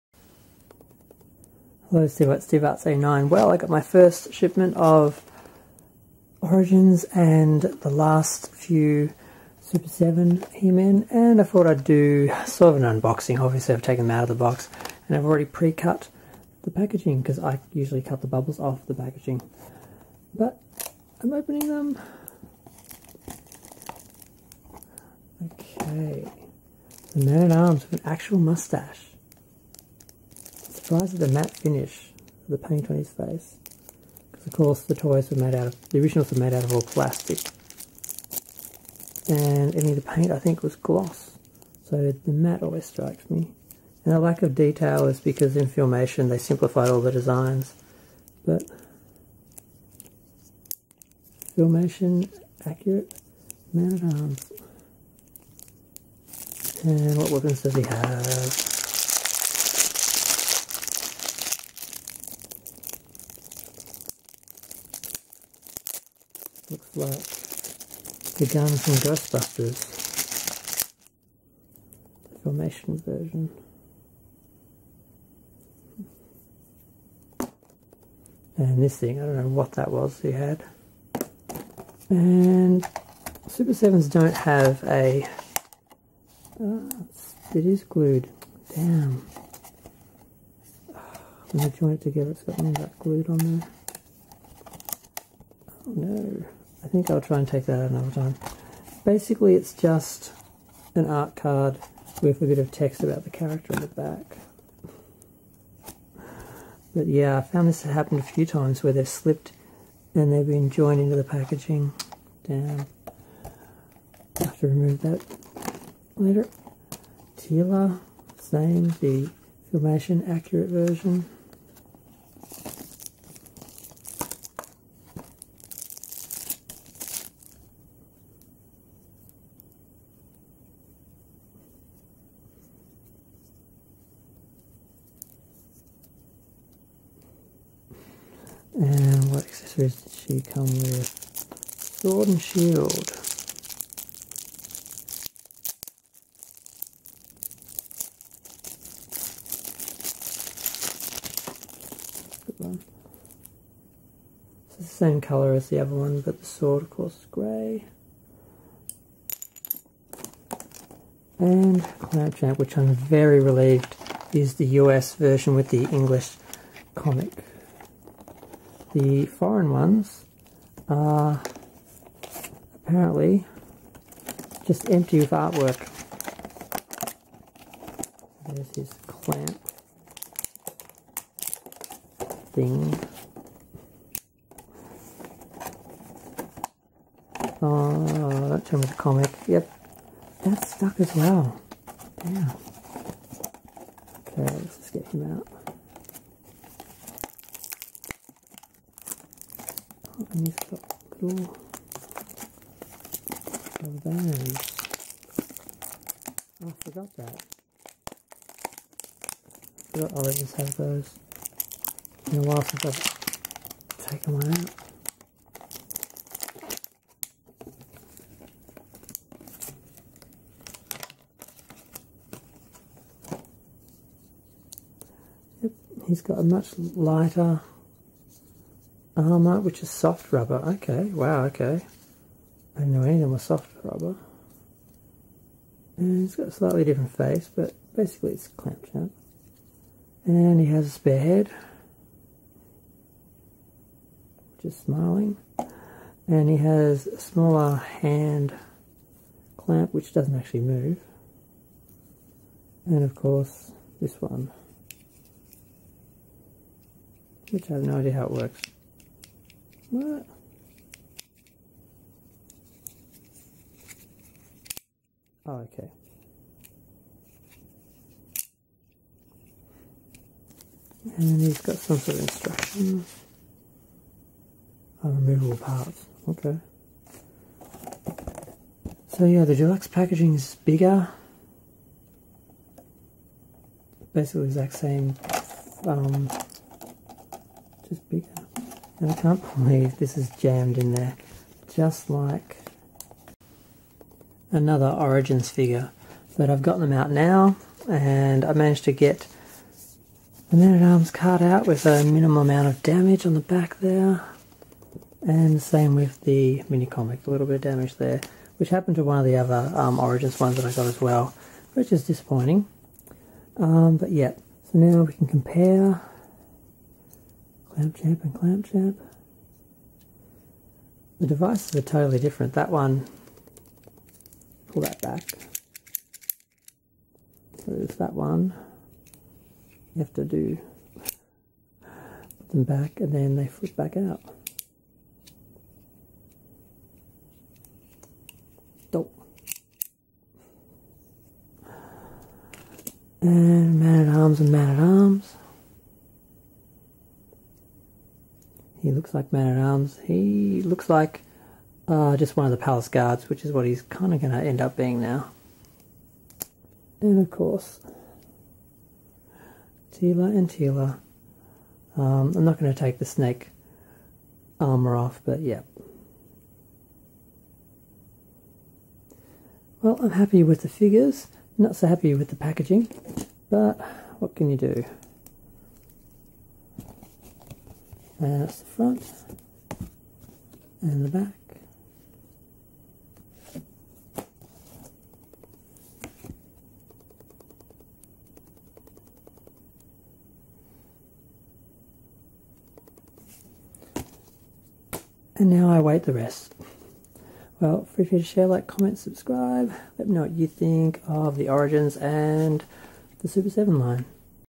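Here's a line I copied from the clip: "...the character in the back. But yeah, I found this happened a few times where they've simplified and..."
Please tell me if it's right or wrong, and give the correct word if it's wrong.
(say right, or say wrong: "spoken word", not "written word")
wrong: "slipped", not "simplified".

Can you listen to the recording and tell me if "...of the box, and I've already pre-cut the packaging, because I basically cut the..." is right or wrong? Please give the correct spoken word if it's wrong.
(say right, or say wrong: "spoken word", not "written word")
wrong: "usually", not "basically".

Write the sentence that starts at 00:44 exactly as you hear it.
And the lack of detail is because in Filmation they simplified all the designs.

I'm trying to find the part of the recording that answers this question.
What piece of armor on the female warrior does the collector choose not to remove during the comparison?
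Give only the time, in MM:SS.
06:03.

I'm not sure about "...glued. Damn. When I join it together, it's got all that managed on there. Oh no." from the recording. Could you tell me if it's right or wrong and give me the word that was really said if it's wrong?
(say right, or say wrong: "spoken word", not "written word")
wrong: "glued", not "managed".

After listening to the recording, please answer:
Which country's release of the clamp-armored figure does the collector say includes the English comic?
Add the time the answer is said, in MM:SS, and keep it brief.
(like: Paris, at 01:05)
US, at 02:44.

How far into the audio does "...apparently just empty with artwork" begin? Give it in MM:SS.
02:52.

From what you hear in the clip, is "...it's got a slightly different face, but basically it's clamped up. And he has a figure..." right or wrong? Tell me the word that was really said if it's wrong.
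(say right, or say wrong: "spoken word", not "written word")
wrong: "spare", not "figure".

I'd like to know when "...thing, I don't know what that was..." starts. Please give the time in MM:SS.
01:18.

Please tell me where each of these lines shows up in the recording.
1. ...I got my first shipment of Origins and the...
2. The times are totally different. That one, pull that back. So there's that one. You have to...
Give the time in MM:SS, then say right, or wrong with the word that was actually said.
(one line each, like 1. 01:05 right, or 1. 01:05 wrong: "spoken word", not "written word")
1. 00:03 right
2. 05:21 wrong: "devices", not "times".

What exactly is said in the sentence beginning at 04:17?
Which I have no idea how it works.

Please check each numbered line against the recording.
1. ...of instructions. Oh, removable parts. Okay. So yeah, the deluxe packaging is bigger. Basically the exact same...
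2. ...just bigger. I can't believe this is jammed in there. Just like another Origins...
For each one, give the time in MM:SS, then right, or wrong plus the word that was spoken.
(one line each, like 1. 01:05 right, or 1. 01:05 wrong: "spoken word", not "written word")
1. 04:32 right
2. 04:47 right.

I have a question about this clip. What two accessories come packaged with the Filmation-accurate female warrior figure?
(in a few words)
Sword and shield.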